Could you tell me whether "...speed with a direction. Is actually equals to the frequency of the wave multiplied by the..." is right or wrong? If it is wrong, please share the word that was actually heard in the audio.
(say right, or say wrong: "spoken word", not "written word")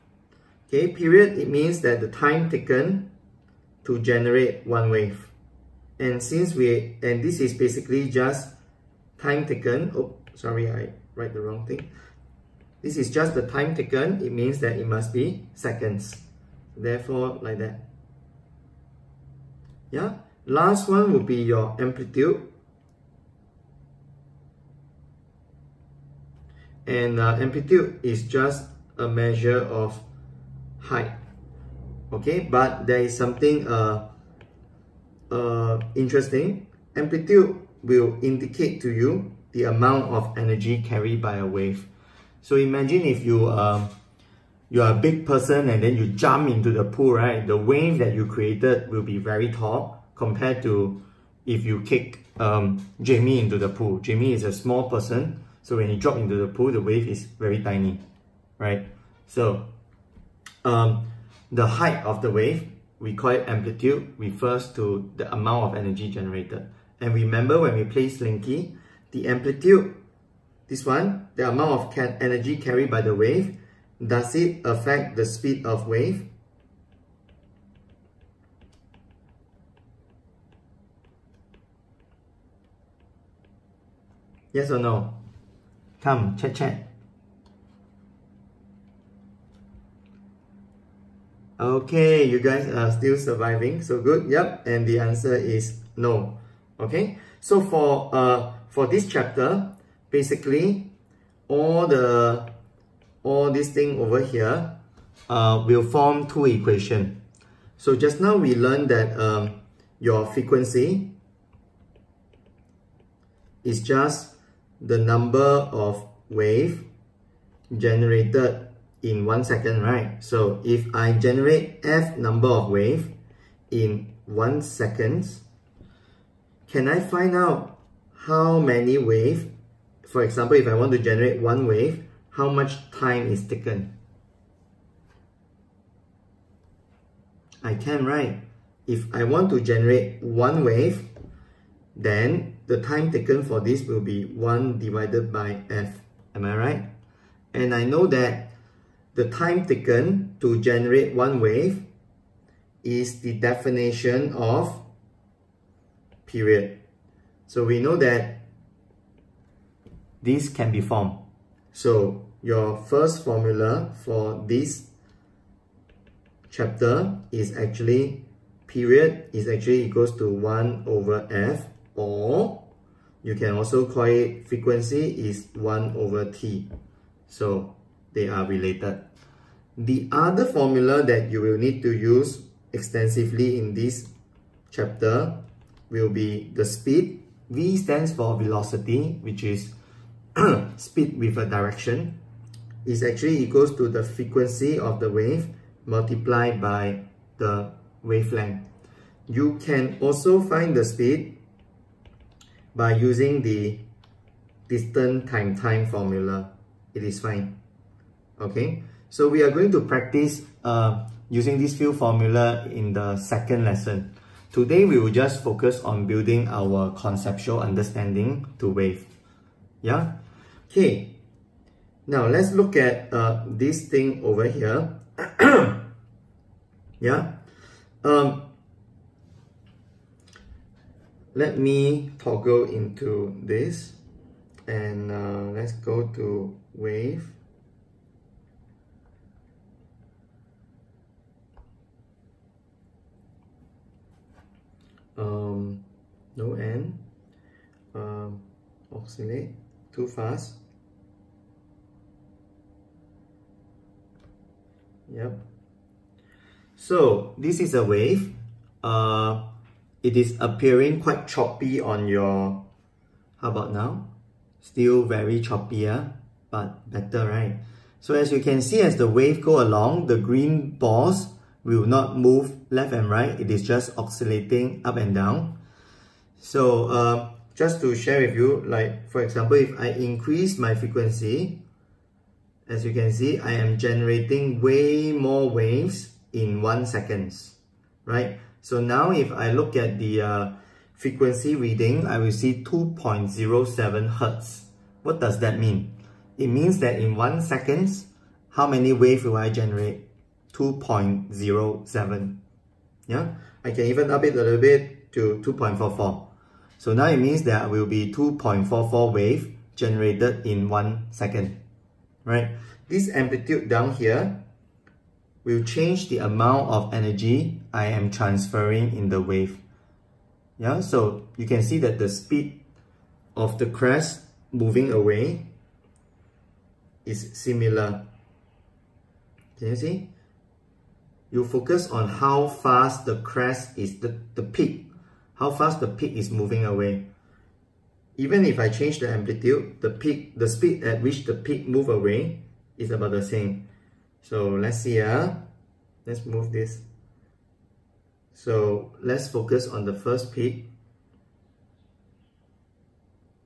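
right.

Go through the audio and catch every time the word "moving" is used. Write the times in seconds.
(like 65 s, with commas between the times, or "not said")
324 s, 336 s.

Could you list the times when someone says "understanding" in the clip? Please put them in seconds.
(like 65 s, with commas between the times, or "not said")
217 s.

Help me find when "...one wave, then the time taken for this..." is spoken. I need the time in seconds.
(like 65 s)
140 s.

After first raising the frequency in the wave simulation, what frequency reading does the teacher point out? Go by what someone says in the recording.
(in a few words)
2.07 Hertz.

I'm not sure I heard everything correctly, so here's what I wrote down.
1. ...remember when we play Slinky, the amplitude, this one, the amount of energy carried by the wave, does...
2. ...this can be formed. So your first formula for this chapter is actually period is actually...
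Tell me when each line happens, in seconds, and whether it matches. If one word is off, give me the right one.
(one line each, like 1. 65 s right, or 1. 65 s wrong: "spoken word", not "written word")
1. 67 s right
2. 160 s right.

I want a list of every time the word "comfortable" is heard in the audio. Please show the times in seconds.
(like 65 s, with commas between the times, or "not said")
not said.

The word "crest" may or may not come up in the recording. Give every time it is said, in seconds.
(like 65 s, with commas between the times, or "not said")
323 s, 333 s.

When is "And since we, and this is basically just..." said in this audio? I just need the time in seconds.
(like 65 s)
5 s.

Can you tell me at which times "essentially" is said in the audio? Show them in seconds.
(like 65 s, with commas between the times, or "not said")
not said.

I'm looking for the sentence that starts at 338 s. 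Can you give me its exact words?
Even if I change the amplitude, the peak, the speed at which the peak move away is about the same.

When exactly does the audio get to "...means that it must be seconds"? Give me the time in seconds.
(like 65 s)
14 s.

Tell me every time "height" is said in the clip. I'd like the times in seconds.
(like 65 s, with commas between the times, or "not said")
30 s, 61 s.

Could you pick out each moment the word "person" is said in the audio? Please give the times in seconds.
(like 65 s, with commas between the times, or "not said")
45 s, 54 s.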